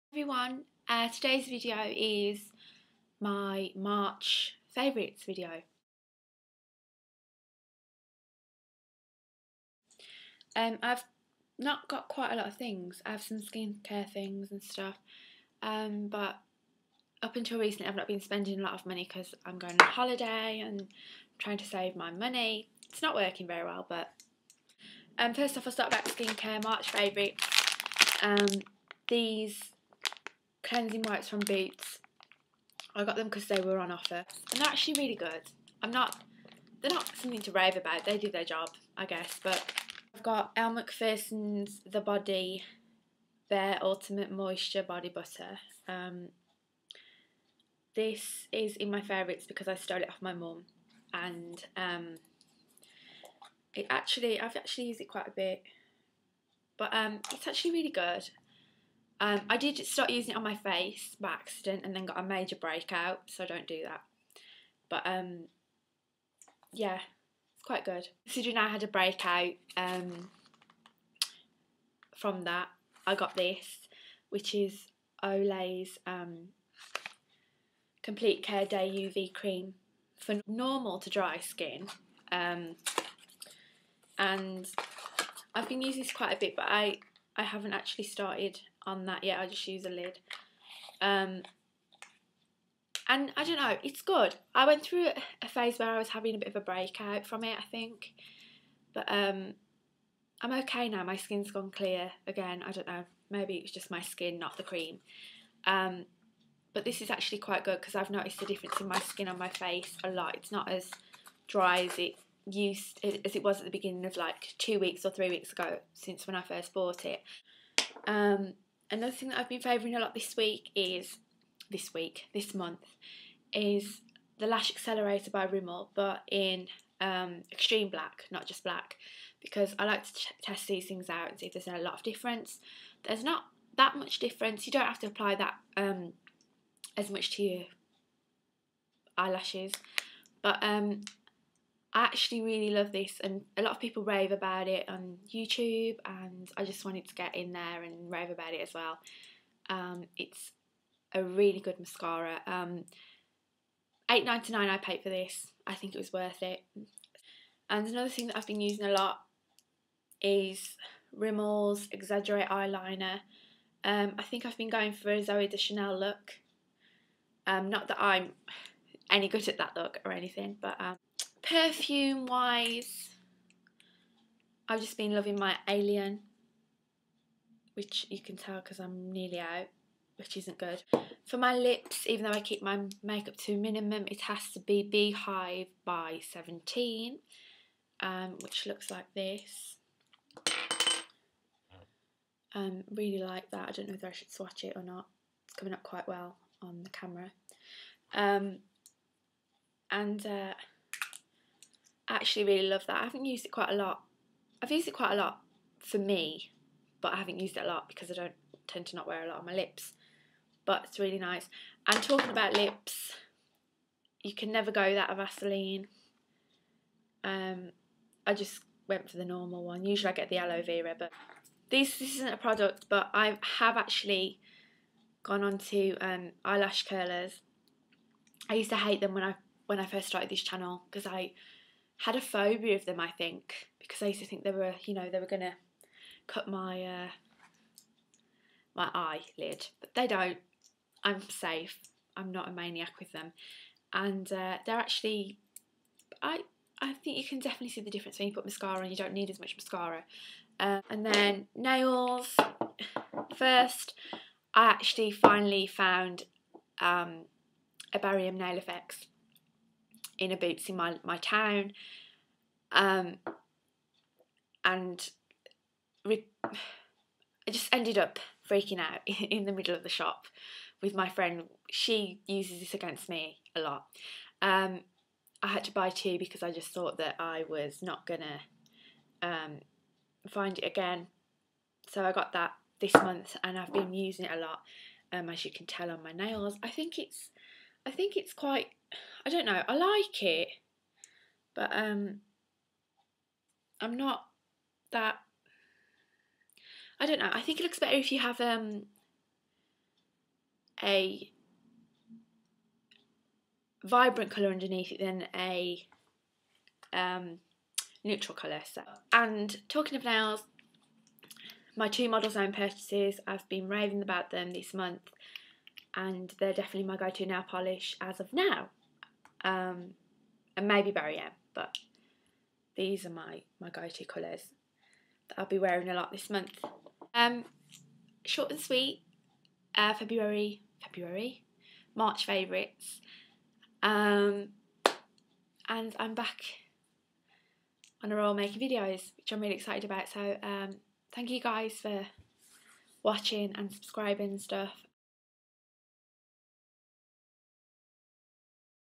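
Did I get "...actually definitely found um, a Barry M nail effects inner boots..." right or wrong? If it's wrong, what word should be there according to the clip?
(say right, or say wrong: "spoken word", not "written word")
wrong: "finally", not "definitely".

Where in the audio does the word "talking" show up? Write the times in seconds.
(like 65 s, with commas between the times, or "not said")
212 s, 309 s.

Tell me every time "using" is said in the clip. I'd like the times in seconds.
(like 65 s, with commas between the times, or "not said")
60 s, 85 s, 158 s, 283 s.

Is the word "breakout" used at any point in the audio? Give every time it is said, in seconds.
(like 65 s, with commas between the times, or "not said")
62 s, 68 s, 96 s.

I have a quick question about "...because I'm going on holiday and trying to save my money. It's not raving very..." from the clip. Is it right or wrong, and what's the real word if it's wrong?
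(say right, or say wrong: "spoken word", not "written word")
wrong: "working", not "raving".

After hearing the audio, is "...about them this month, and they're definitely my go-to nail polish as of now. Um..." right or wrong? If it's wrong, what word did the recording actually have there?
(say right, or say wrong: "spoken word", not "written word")
right.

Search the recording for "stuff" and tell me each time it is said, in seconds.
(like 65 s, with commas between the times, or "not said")
14 s, 344 s.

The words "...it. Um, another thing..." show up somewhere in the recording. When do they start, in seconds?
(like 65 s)
117 s.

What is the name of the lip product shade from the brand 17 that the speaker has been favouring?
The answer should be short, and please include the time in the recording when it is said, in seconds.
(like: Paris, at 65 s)
Beehive, at 184 s.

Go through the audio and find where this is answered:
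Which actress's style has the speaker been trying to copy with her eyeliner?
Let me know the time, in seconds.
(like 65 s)
165 s.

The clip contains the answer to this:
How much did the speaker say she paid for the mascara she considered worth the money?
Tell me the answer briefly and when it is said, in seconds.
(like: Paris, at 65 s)
£8.99, at 154 s.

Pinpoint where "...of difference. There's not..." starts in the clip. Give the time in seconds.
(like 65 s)
131 s.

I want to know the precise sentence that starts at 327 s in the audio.
Um, short and sweet, uh, February, February, March favourites.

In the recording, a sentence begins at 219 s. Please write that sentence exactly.
Usually I get the aloe vera, but this, this isn't a product, but I have actually gone on to um, eyelash curlers.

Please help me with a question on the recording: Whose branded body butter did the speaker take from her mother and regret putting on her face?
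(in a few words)
Elle Macpherson.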